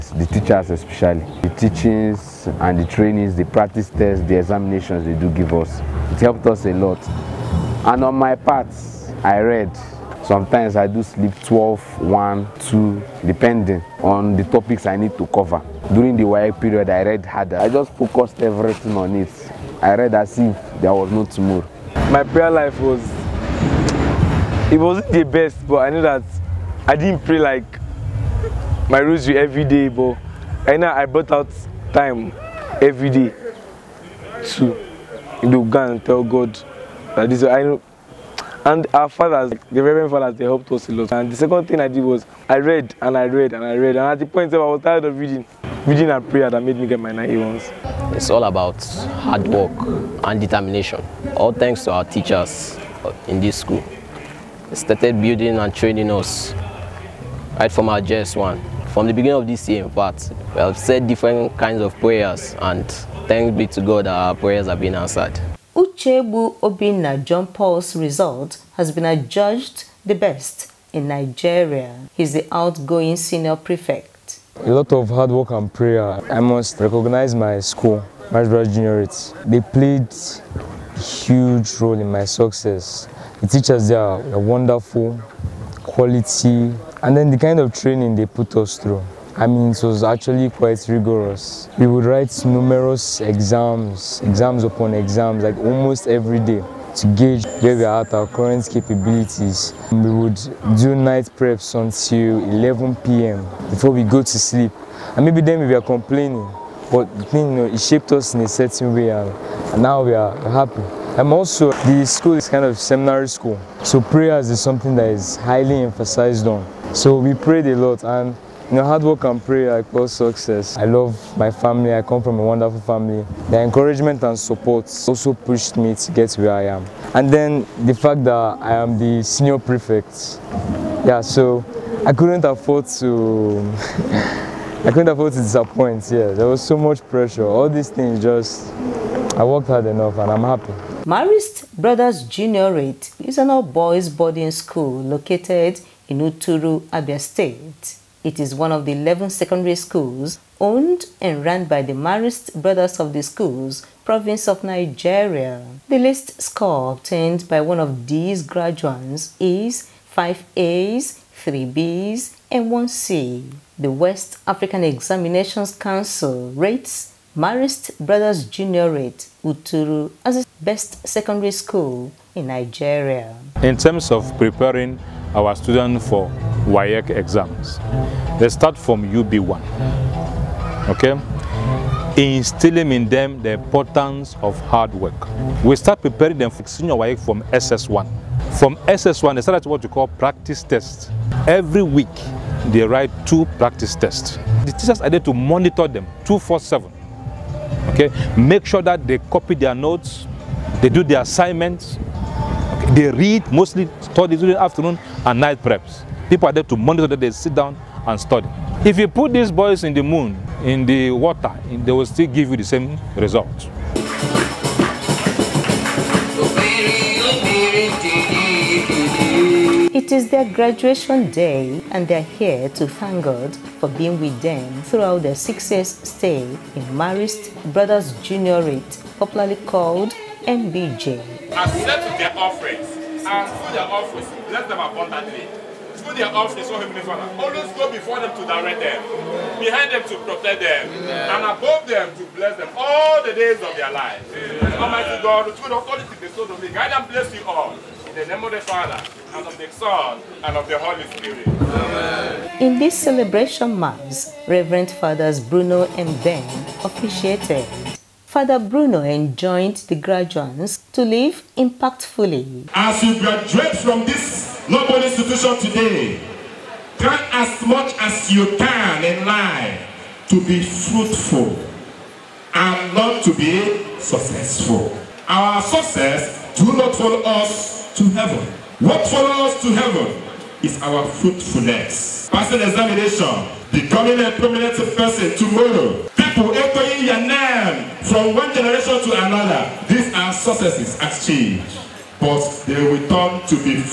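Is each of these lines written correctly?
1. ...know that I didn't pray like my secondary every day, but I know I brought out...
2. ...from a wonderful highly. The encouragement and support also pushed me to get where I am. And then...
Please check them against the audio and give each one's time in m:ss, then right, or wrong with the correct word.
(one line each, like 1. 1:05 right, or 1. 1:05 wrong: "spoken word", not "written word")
1. 0:25 wrong: "rosary", not "secondary"
2. 2:02 wrong: "family", not "highly".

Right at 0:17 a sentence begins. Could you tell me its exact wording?
I just focused everything on it.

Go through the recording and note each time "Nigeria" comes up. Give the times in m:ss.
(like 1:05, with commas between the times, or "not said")
1:11, 2:34, 2:52.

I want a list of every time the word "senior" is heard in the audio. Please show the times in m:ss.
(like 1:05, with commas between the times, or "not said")
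1:13, 2:09, 3:06.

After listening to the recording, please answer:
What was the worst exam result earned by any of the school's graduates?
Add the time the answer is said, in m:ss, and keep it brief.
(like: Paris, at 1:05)
5 A's, 3 B's, 1 C, at 2:40.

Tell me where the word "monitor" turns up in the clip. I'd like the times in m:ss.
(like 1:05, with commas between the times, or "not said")
3:15, 3:26.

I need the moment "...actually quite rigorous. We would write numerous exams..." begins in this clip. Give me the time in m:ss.
1:30.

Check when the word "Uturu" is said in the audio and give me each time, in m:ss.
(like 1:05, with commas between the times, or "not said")
2:26, 2:49.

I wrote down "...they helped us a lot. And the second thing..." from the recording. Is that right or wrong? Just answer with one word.
right.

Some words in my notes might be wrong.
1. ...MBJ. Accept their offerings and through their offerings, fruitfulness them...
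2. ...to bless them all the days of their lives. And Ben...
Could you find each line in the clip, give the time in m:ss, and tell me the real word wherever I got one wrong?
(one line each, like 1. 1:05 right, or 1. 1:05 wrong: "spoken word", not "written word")
1. 3:50 wrong: "bless", not "fruitfulness"
2. 4:02 wrong: "Almighty", not "Ben".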